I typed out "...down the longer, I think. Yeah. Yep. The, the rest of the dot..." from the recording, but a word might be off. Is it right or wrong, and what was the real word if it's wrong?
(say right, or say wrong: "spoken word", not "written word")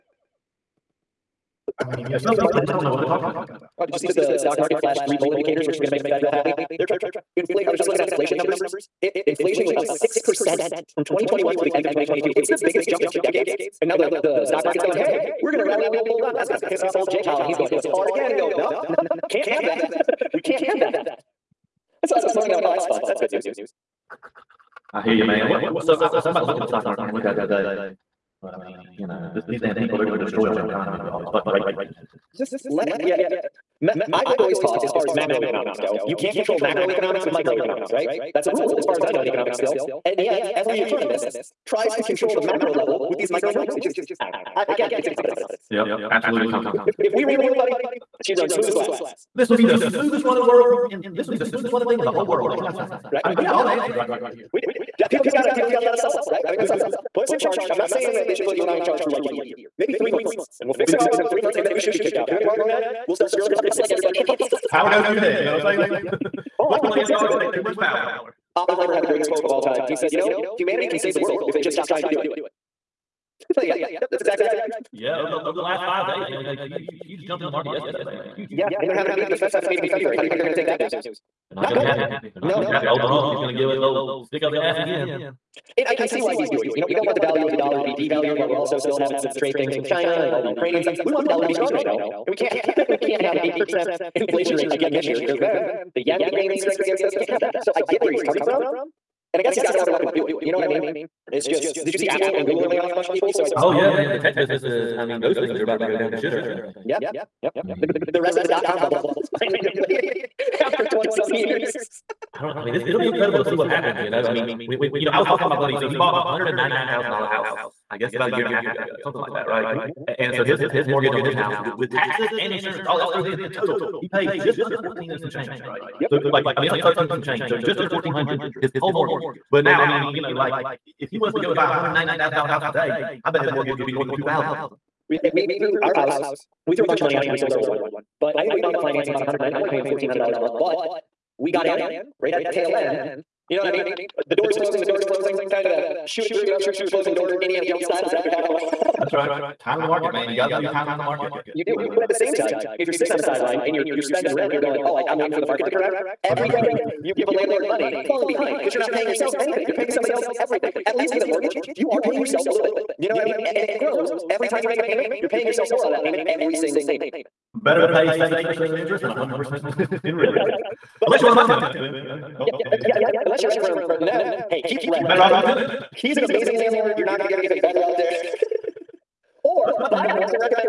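wrong: "shitter", not "longer".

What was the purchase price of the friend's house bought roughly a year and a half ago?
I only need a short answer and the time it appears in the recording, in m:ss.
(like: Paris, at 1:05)
$199,000, at 1:56.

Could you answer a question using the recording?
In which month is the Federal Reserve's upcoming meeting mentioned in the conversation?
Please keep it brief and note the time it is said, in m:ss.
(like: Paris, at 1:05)
February, at 1:19.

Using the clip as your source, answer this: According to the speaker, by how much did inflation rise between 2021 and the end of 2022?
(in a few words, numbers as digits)
6 percent.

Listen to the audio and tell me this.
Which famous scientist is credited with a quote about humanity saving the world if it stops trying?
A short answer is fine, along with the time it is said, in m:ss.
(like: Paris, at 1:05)
Oppenheimer, at 1:08.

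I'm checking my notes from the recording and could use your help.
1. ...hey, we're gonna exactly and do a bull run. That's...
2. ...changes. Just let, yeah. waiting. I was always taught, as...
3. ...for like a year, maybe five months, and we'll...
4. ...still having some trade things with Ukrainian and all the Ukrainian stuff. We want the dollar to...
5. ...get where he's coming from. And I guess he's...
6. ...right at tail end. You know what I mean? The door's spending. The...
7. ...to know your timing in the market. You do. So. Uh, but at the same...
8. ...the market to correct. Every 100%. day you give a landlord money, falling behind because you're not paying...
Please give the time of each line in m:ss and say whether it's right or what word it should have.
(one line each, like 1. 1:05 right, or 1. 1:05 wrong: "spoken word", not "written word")
1. 0:14 wrong: "rally", not "exactly"
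2. 0:31 wrong: "nothing", not "waiting"
3. 0:59 wrong: "three", not "five"
4. 1:28 wrong: "China", not "Ukrainian"
5. 1:37 right
6. 2:22 wrong: "closing", not "spending"
7. 2:30 right
8. 2:35 right.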